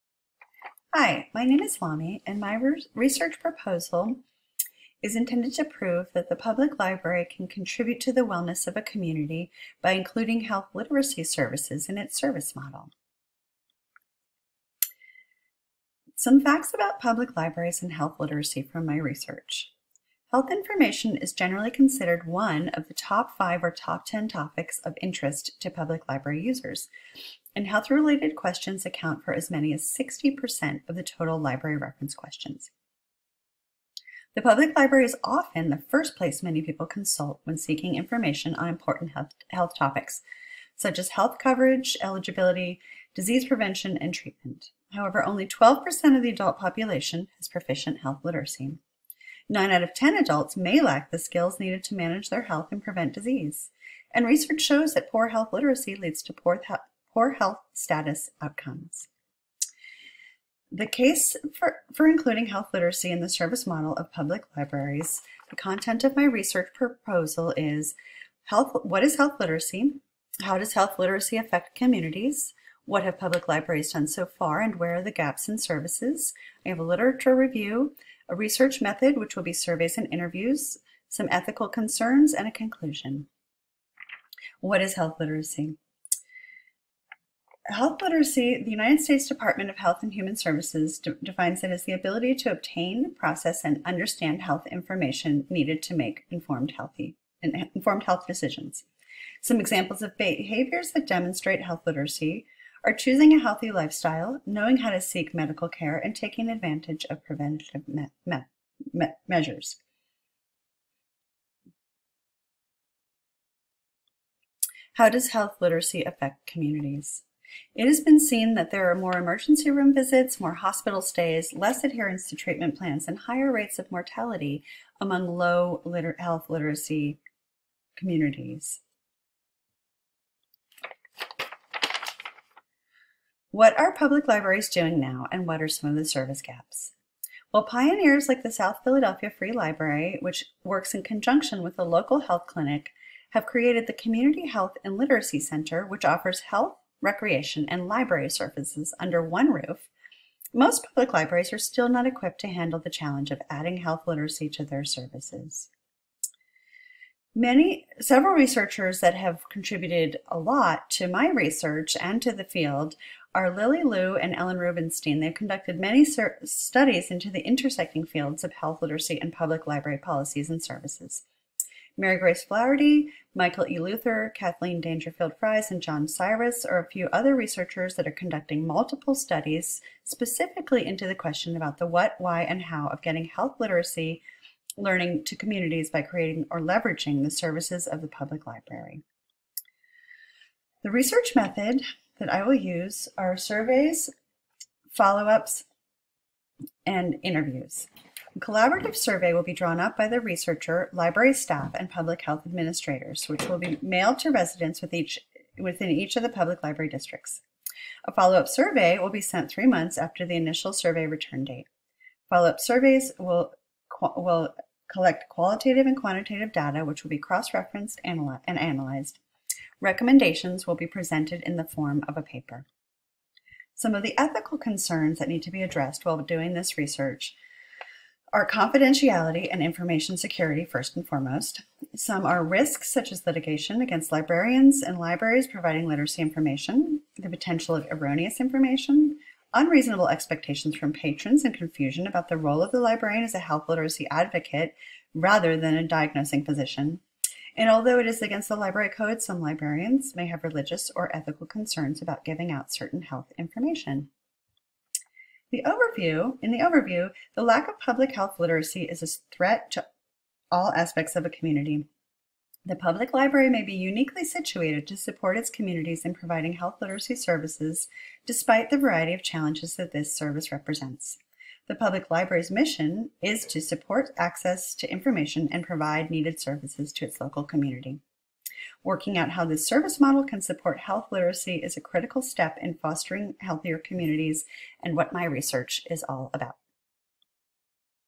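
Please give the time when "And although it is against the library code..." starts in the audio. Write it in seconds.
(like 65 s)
247 s.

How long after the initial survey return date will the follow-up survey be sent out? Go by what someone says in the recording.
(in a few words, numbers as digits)
3 months.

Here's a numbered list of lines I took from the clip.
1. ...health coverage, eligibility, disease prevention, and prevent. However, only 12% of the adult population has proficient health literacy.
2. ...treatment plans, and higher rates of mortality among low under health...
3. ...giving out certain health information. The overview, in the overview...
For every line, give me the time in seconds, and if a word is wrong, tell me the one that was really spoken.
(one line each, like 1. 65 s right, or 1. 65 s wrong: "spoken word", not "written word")
1. 41 s wrong: "treatment", not "prevent"
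2. 122 s wrong: "liter", not "under"
3. 252 s right.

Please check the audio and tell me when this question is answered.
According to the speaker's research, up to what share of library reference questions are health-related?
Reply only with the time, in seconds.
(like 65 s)
29 s.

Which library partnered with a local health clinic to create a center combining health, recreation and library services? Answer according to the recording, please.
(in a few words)
South Philadelphia Free Library.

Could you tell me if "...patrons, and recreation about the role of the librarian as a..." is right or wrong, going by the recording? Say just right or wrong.
wrong.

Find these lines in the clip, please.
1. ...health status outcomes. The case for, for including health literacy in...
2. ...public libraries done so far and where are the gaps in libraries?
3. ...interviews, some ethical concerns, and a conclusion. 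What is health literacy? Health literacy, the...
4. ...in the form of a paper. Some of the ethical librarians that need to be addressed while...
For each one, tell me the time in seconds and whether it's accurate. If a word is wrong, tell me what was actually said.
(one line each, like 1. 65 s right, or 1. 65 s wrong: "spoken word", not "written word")
1. 57 s right
2. 73 s wrong: "services", not "libraries"
3. 80 s right
4. 221 s wrong: "concerns", not "librarians".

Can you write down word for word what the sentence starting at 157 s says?
Many, several researchers that have contributed a lot to my research and to the field are Lily Liu and Ellen Rubenstein.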